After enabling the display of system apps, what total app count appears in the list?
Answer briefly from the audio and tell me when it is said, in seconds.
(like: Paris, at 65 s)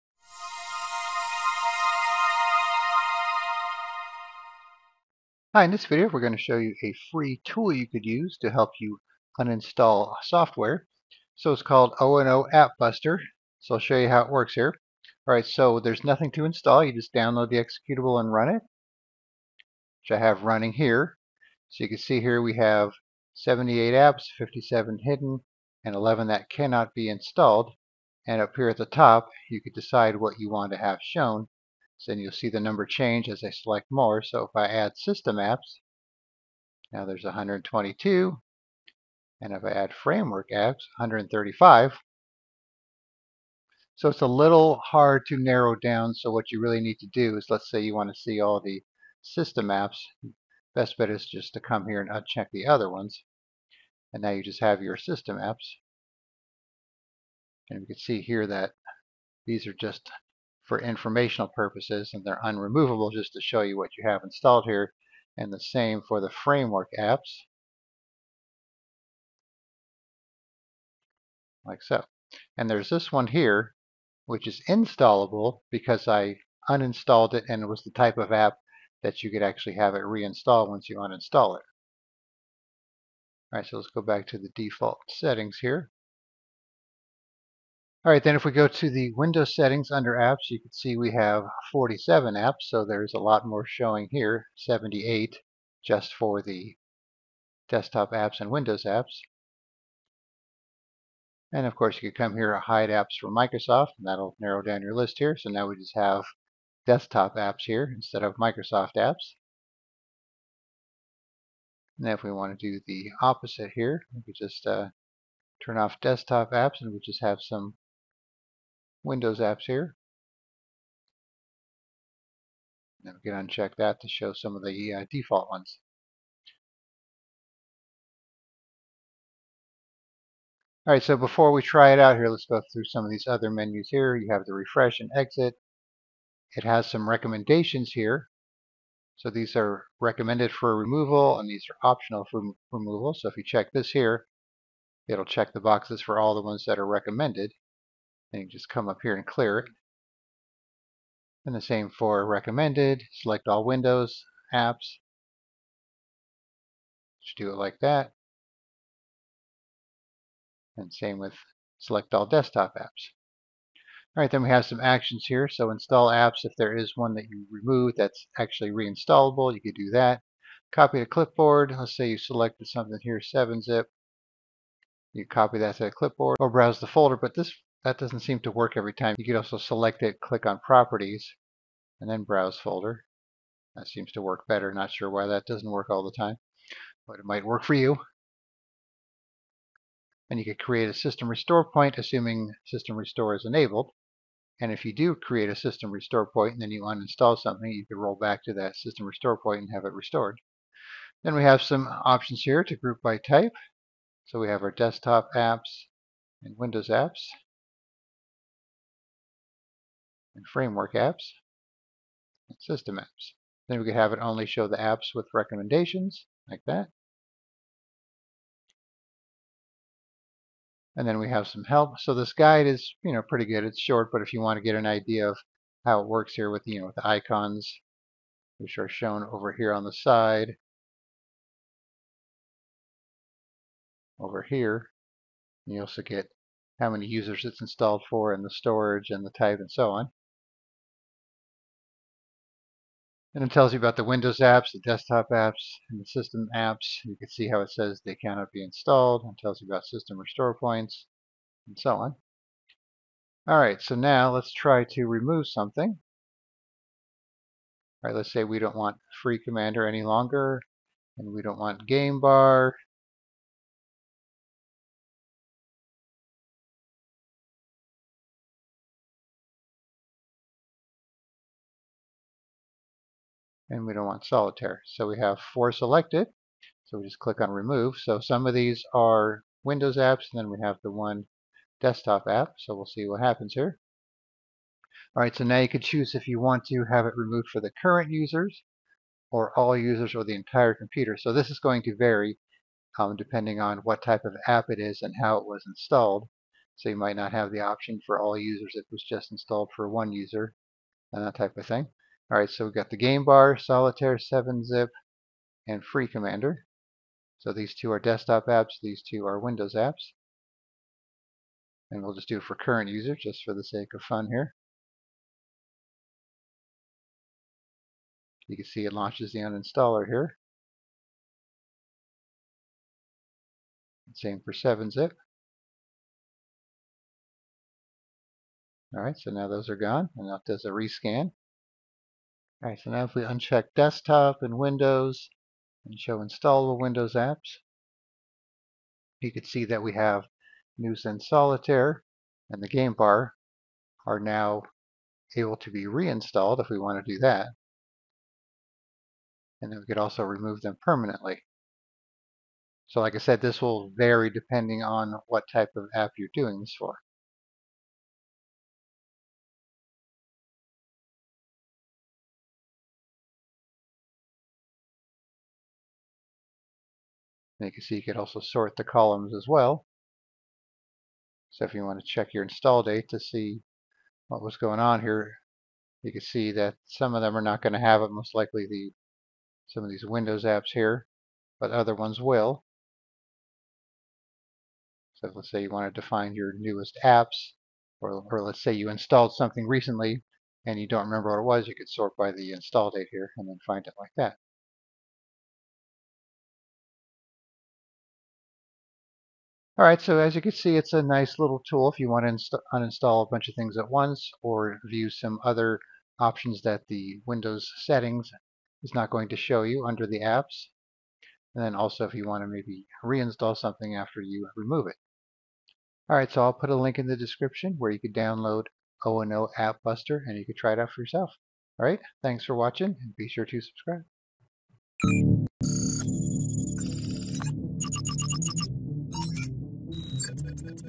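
122, at 37 s.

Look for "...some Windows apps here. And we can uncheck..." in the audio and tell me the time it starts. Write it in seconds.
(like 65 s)
117 s.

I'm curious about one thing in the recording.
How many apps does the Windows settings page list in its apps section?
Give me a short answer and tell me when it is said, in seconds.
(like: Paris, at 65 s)
47, at 91 s.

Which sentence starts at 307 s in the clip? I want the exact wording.
So these two are desktop apps, these two are Windows apps.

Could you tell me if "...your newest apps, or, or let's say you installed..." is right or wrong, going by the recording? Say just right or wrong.
right.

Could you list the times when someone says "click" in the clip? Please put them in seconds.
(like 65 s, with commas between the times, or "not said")
180 s, 277 s.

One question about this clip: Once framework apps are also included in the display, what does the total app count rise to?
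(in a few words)
135.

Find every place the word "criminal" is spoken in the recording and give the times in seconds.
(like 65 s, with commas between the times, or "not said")
not said.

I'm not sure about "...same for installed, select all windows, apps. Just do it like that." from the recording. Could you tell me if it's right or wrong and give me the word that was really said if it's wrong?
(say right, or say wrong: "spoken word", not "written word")
wrong: "recommended", not "installed".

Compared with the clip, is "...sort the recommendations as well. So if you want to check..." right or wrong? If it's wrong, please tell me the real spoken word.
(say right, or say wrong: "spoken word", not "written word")
wrong: "columns", not "recommendations".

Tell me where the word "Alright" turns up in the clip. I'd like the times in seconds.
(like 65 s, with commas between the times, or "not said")
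15 s, 83 s.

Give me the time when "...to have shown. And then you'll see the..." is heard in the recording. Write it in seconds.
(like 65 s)
30 s.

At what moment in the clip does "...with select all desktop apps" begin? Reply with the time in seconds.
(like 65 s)
161 s.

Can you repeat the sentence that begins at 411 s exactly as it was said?
And then also if you want to maybe reinstall something after you remove it.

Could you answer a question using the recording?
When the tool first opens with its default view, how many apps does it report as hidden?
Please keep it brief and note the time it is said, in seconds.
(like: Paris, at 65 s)
57, at 24 s.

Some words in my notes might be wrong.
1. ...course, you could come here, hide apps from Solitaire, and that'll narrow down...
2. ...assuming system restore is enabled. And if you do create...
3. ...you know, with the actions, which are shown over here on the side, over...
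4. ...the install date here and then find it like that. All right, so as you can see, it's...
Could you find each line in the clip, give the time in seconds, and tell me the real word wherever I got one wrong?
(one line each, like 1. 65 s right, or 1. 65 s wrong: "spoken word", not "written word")
1. 101 s wrong: "Microsoft", not "Solitaire"
2. 191 s right
3. 226 s wrong: "icons", not "actions"
4. 392 s right.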